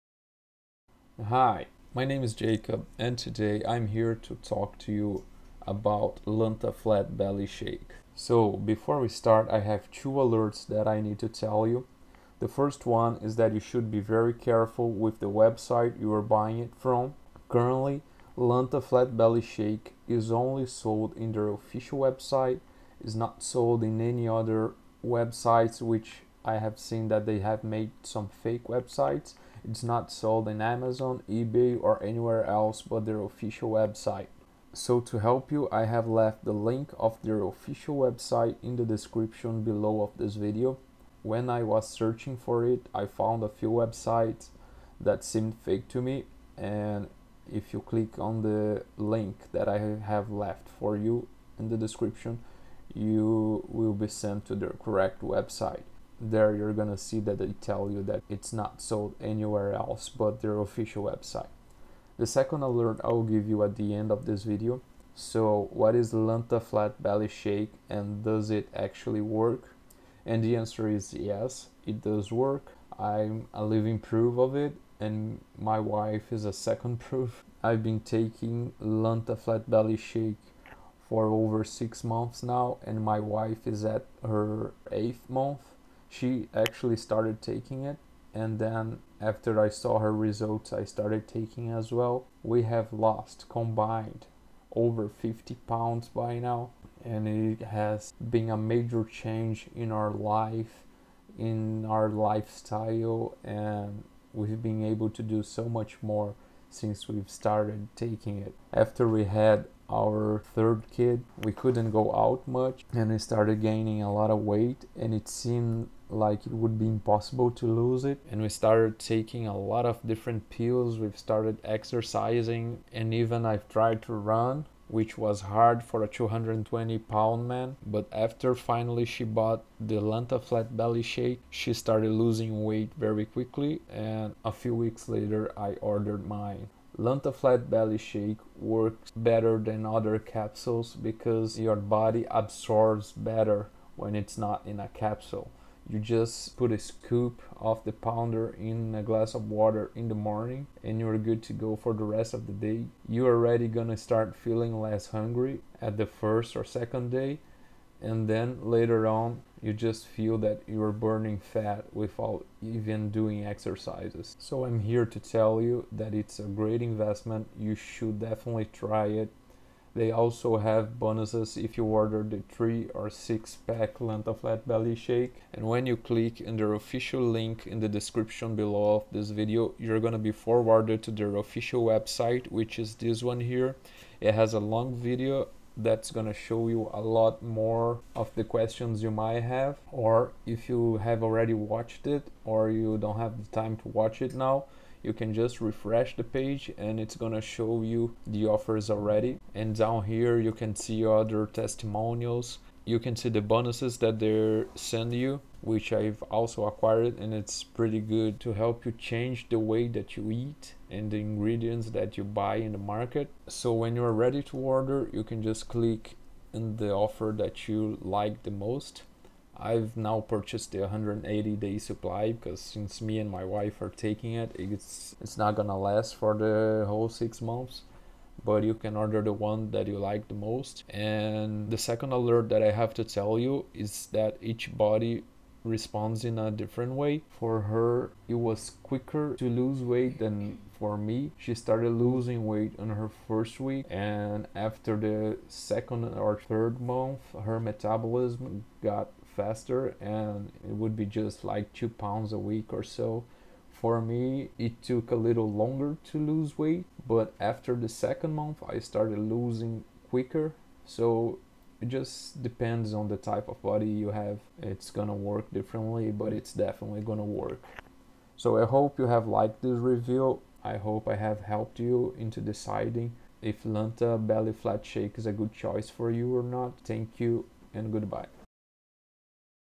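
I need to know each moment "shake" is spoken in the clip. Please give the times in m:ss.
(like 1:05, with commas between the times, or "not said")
0:07, 0:19, 1:07, 1:19, 2:11, 2:17, 2:54, 4:34.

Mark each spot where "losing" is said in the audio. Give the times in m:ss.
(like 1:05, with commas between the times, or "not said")
2:12, 4:01, 4:19.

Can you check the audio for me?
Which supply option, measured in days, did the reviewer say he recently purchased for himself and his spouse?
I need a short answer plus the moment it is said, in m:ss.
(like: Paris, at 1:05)
180 day, at 3:40.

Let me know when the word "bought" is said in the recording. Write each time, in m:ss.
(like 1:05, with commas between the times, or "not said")
2:09.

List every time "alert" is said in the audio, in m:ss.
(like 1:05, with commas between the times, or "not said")
0:10, 1:02, 3:52.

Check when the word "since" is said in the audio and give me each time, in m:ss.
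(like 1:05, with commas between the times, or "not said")
1:46, 3:42.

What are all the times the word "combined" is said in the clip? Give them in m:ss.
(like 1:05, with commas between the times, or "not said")
1:33.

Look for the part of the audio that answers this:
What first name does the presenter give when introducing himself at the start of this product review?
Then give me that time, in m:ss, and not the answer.
0:02.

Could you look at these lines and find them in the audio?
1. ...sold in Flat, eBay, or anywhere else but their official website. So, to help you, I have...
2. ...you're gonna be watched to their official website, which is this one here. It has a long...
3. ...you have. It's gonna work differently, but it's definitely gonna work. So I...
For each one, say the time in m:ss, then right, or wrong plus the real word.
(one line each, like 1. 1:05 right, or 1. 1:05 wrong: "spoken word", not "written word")
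1. 0:30 wrong: "Amazon", not "Flat"
2. 2:59 wrong: "forwarded", not "watched"
3. 4:23 right.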